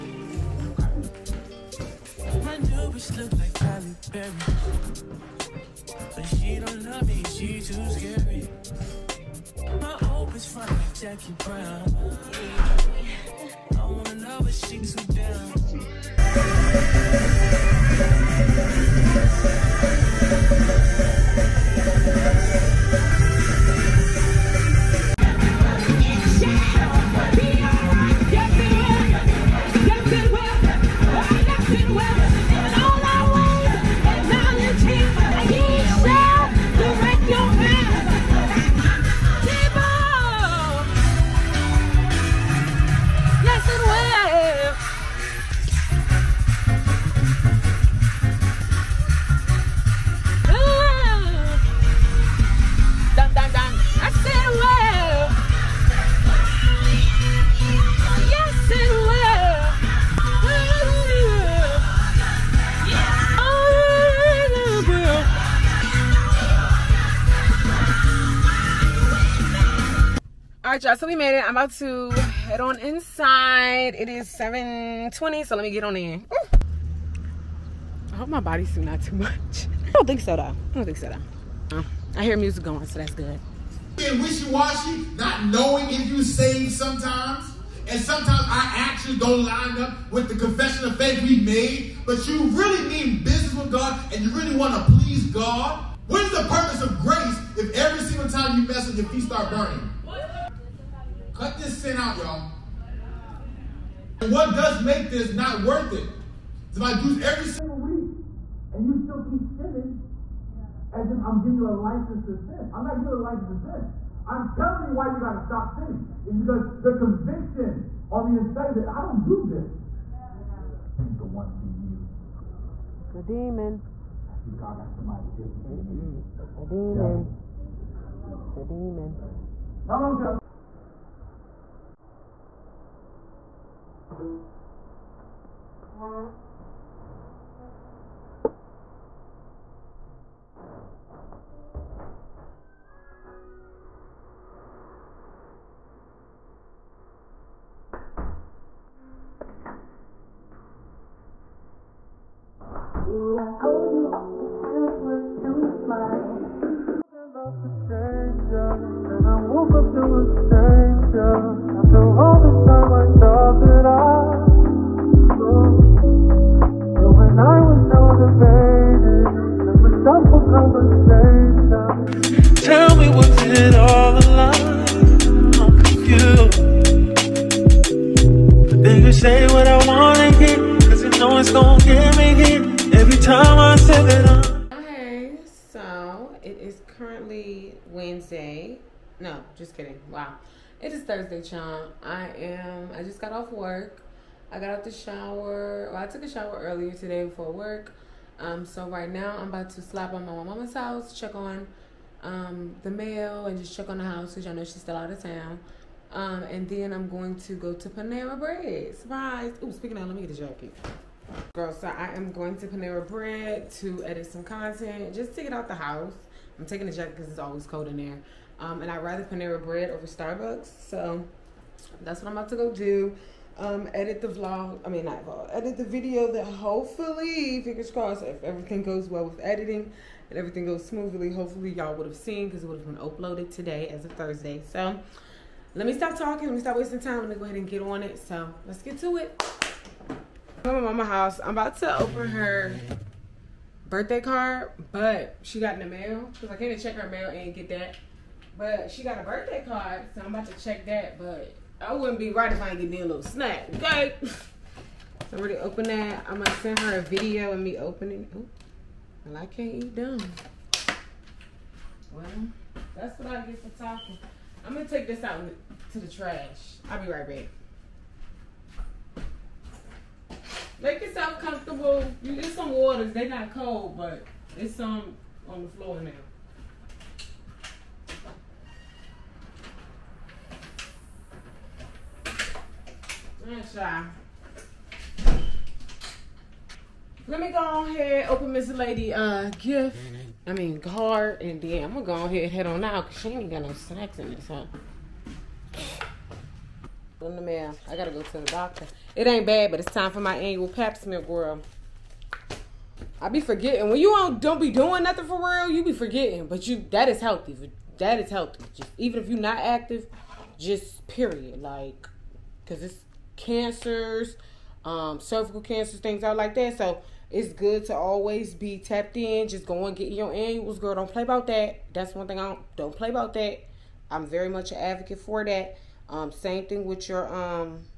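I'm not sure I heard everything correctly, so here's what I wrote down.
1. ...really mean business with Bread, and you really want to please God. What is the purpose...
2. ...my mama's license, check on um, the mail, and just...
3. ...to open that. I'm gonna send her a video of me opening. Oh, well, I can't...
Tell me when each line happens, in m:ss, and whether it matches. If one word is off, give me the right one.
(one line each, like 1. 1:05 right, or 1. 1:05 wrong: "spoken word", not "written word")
1. 1:32 wrong: "God", not "Bread"
2. 3:20 wrong: "house", not "license"
3. 4:15 right.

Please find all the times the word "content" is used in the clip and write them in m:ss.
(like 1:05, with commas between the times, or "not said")
3:34.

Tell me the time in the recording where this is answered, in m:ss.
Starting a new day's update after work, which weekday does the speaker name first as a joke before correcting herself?
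3:07.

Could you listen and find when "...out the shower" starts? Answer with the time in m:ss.
3:14.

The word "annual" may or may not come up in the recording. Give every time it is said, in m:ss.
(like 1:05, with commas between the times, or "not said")
5:00, 5:20.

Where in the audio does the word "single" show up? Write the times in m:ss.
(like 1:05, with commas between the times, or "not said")
1:38, 1:47.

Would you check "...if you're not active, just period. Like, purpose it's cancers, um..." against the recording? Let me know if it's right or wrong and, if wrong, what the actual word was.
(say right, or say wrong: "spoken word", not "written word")
wrong: "cause", not "purpose".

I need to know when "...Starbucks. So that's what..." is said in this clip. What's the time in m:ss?
3:40.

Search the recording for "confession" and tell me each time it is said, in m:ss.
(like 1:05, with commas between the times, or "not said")
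1:30.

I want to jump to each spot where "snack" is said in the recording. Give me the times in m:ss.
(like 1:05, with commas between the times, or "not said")
4:13, 4:53.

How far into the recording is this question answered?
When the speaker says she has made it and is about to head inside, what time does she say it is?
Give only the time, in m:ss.
1:14.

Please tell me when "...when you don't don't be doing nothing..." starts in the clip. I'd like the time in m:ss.
5:03.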